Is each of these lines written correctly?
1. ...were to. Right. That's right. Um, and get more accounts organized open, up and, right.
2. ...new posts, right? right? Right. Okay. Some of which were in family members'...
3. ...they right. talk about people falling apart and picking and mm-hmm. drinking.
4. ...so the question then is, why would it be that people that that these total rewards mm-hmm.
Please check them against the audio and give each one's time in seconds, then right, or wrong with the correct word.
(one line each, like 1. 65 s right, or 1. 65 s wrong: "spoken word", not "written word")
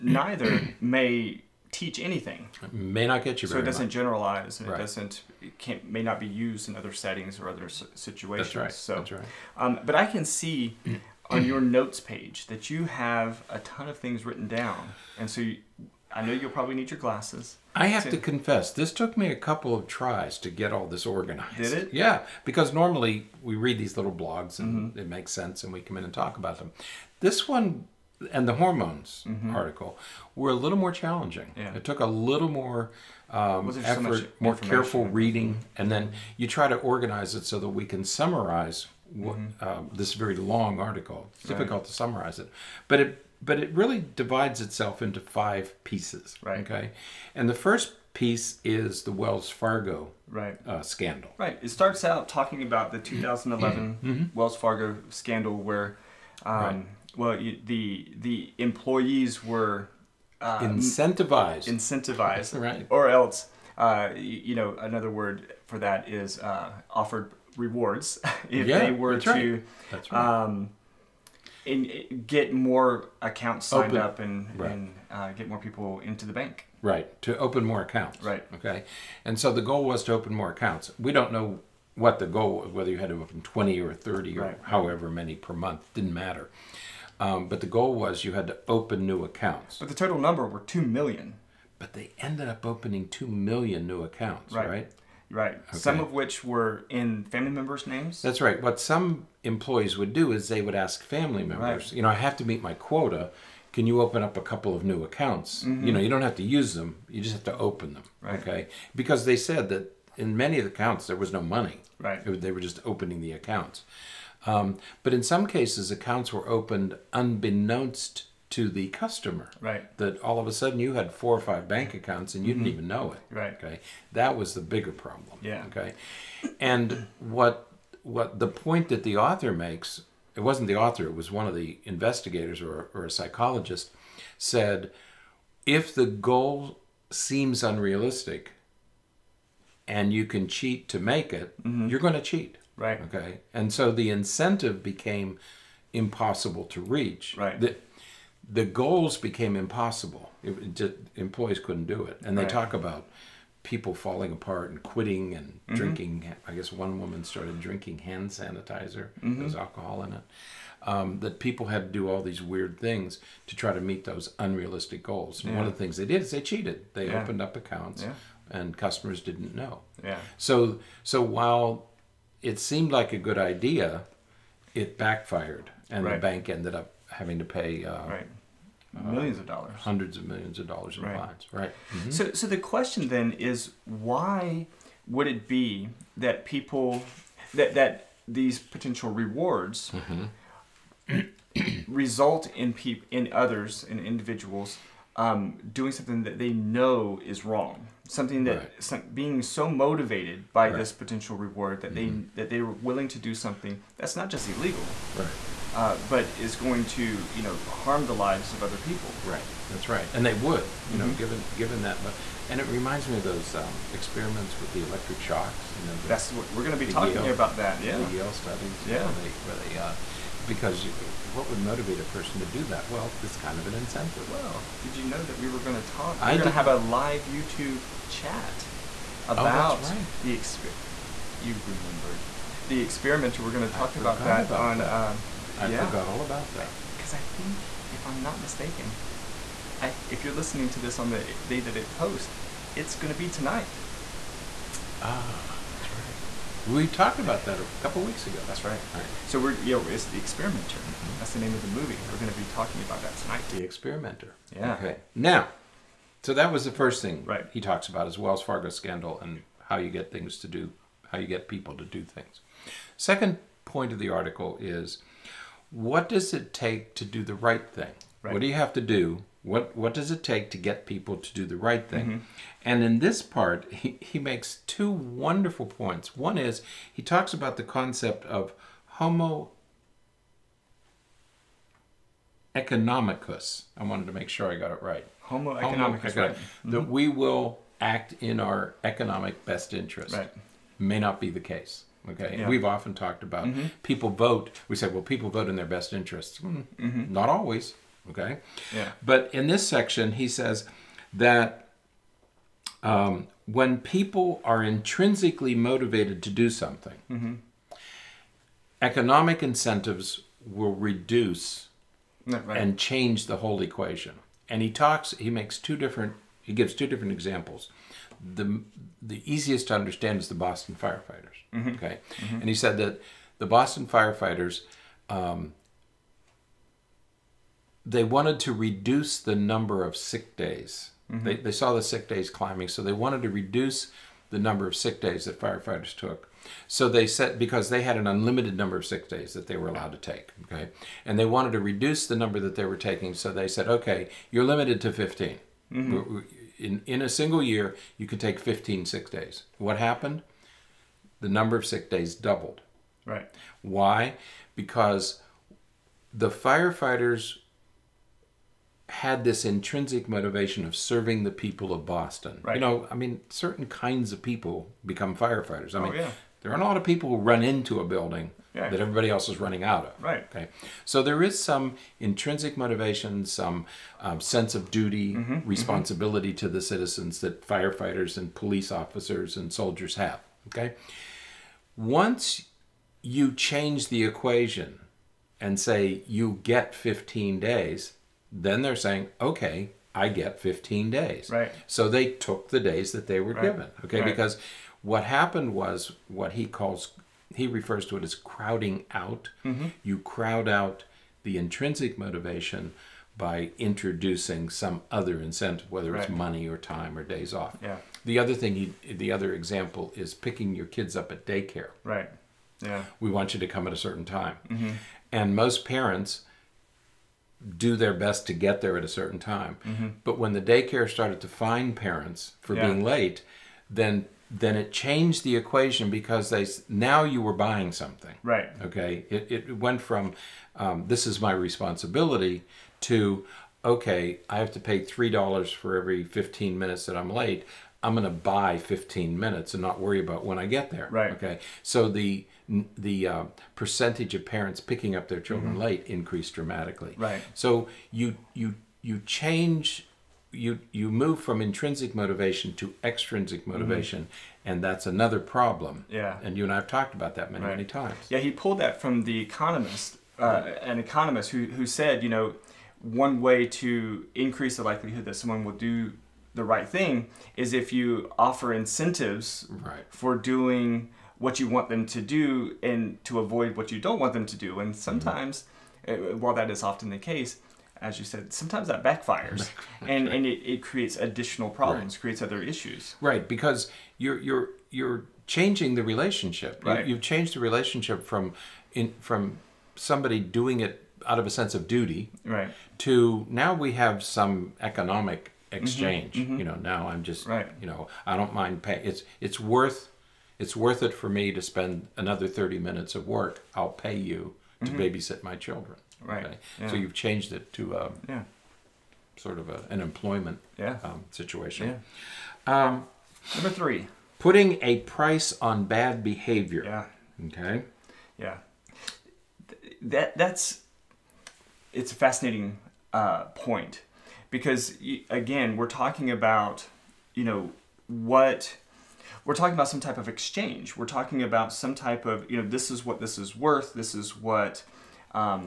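1. 68 s wrong: "signed", not "organized"
2. 93 s wrong: "accounts", not "posts"
3. 152 s wrong: "quitting", not "picking"
4. 182 s wrong: "potential", not "total".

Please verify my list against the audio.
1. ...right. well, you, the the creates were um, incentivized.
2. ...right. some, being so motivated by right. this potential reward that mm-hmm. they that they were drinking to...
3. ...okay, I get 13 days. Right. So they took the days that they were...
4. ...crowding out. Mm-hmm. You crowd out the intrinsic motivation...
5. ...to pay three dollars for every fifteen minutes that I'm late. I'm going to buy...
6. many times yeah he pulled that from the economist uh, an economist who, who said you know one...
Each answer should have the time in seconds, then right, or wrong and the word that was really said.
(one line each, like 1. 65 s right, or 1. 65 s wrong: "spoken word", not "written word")
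1. 56 s wrong: "employees", not "creates"
2. 198 s wrong: "willing", not "drinking"
3. 389 s wrong: "15", not "13"
4. 398 s right
5. 434 s right
6. 457 s right.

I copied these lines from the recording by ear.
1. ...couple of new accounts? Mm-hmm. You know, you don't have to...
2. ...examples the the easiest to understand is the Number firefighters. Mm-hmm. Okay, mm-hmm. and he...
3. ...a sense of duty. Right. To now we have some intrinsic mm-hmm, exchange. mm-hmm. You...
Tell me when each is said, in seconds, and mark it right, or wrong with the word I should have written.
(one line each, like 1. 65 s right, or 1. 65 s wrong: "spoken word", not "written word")
1. 104 s right
2. 317 s wrong: "Boston", not "Number"
3. 491 s wrong: "economic", not "intrinsic".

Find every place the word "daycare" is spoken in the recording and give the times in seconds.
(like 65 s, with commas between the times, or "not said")
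411 s, 420 s.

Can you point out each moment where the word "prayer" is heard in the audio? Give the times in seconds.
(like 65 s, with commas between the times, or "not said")
not said.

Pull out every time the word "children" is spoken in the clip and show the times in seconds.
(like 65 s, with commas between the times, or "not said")
445 s, 505 s.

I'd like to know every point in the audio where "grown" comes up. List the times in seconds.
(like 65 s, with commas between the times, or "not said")
not said.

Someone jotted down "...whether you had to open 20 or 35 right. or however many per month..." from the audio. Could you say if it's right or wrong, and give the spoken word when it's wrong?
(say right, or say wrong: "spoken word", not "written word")
wrong: "30", not "35".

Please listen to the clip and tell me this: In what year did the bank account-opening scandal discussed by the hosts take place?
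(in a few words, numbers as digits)
2011.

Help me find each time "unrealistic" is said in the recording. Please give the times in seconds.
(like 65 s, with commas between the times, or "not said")
137 s, 164 s.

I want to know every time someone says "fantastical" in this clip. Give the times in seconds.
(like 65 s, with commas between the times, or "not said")
not said.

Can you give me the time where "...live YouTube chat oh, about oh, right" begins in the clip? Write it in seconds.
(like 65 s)
226 s.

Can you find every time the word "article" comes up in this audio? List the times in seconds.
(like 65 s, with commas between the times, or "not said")
29 s, 40 s, 264 s.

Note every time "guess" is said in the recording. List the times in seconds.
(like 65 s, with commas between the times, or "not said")
156 s.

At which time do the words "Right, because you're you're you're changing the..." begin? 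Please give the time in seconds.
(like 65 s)
483 s.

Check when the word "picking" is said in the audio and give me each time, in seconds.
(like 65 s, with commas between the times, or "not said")
410 s, 444 s.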